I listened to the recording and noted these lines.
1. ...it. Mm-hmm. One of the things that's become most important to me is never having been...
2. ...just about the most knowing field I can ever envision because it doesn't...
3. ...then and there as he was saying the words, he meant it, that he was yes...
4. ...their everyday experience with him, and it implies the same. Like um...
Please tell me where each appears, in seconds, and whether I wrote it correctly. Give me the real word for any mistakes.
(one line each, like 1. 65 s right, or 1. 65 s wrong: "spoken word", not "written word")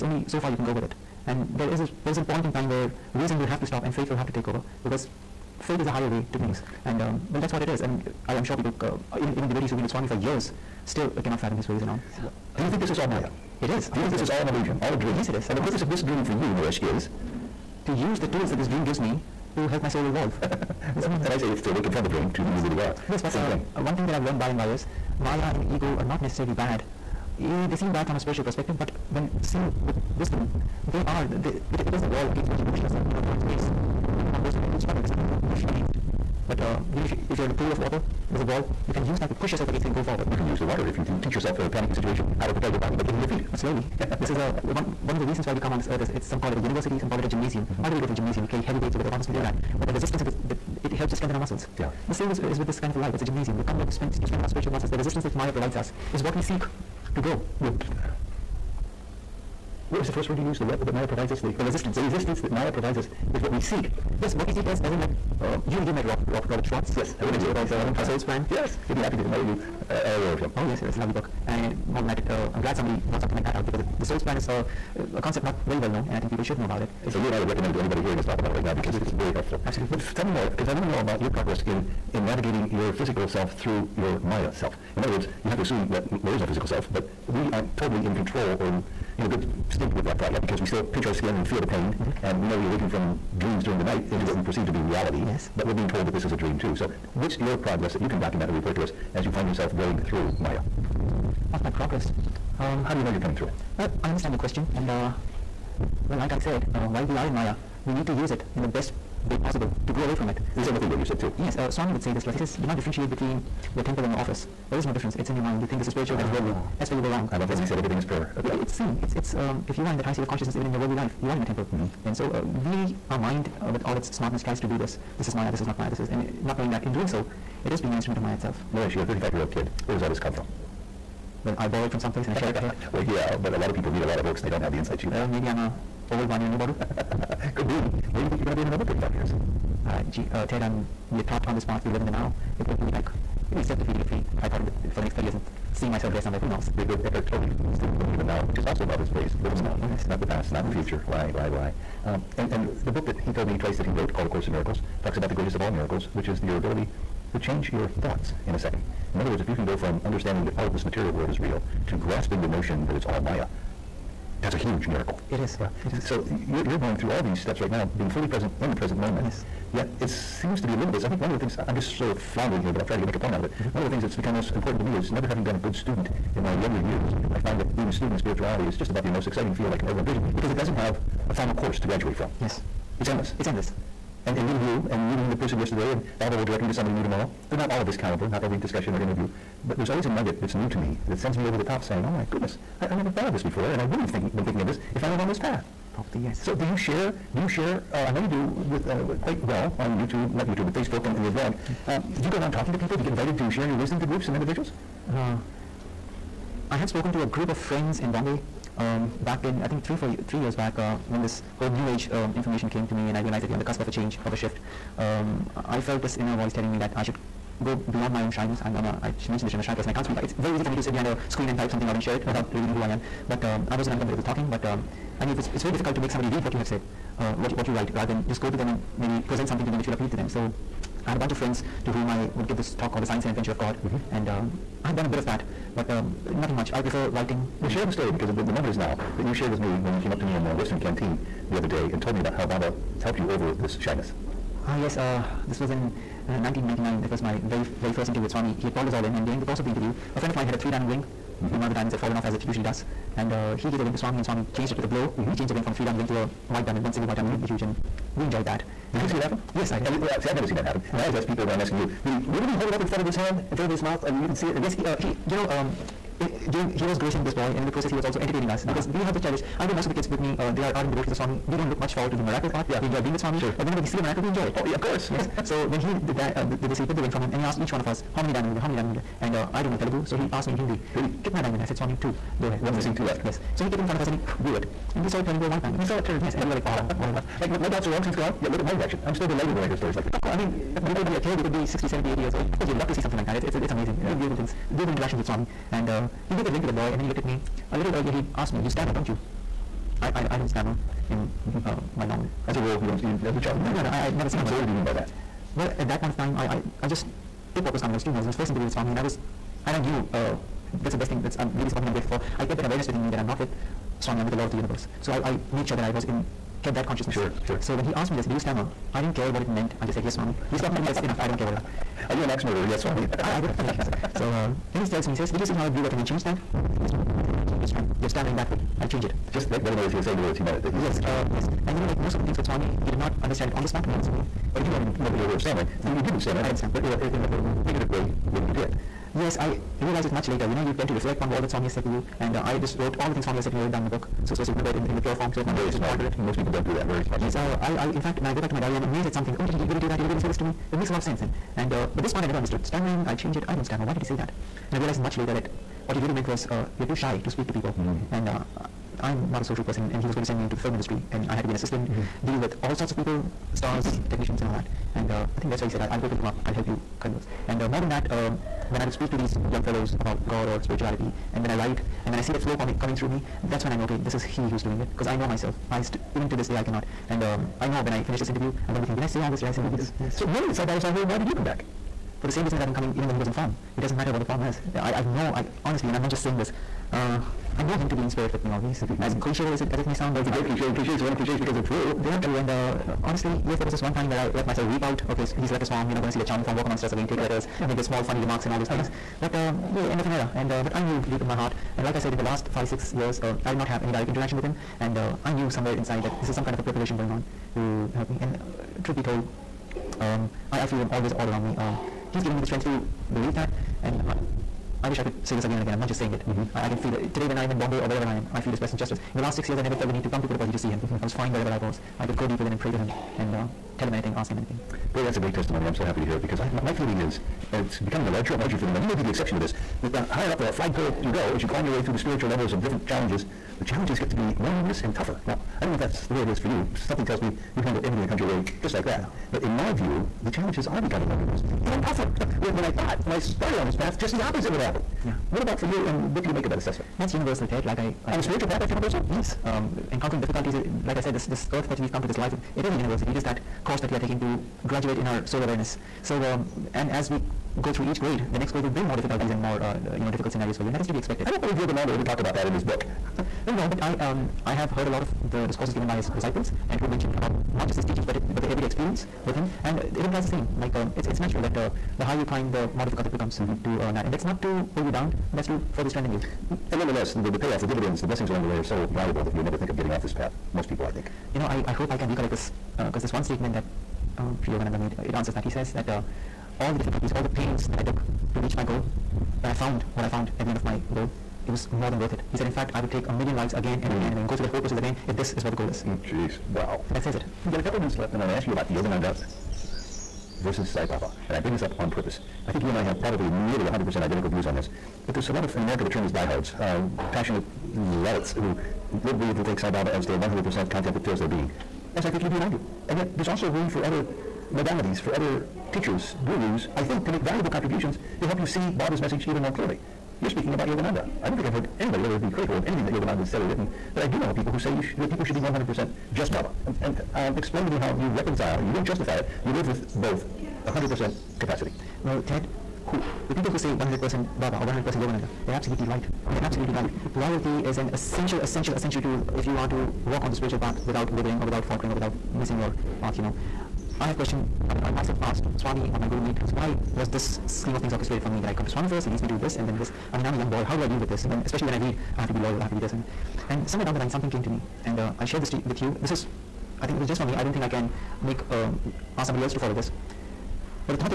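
1. 173 s right
2. 178 s wrong: "exciting", not "knowing"
3. 329 s right
4. 468 s right.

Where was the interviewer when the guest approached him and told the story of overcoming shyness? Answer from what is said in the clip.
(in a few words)
Western Canteen.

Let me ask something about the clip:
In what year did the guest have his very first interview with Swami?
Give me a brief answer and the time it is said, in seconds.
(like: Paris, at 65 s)
1999, at 246 s.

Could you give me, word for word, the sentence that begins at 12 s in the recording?
Do you um, think this is all Maya?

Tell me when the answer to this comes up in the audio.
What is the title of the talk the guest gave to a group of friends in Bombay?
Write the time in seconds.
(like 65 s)
233 s.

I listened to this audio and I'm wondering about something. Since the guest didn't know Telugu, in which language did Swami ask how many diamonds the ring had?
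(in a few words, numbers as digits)
Hindi.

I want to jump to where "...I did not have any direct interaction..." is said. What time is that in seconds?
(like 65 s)
403 s.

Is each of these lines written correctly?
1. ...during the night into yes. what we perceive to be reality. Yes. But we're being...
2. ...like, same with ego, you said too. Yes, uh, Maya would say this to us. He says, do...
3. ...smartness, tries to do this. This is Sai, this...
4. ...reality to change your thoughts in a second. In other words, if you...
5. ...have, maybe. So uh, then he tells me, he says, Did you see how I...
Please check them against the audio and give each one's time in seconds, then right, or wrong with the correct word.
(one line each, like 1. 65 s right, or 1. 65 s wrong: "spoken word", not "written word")
1. 93 s right
2. 110 s wrong: "Swami", not "Maya"
3. 124 s wrong: "Maya", not "Sai"
4. 156 s wrong: "ability", not "reality"
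5. 323 s right.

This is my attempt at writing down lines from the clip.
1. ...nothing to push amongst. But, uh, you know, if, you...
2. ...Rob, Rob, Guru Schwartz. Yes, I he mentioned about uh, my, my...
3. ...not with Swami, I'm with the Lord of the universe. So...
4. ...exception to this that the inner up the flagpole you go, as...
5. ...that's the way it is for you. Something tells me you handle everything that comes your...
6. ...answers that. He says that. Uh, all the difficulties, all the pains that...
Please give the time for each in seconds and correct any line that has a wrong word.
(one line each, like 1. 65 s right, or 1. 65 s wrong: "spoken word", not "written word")
1. 35 s wrong: "against", not "amongst"
2. 66 s wrong: "Robert", not "Guru"
3. 313 s right
4. 429 s wrong: "higher", not "inner"
5. 435 s right
6. 485 s right.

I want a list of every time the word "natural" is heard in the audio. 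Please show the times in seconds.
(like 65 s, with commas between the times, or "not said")
471 s.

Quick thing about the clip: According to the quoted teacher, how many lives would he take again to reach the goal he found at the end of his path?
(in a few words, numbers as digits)
a million.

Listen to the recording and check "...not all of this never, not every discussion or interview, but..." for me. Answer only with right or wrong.
wrong.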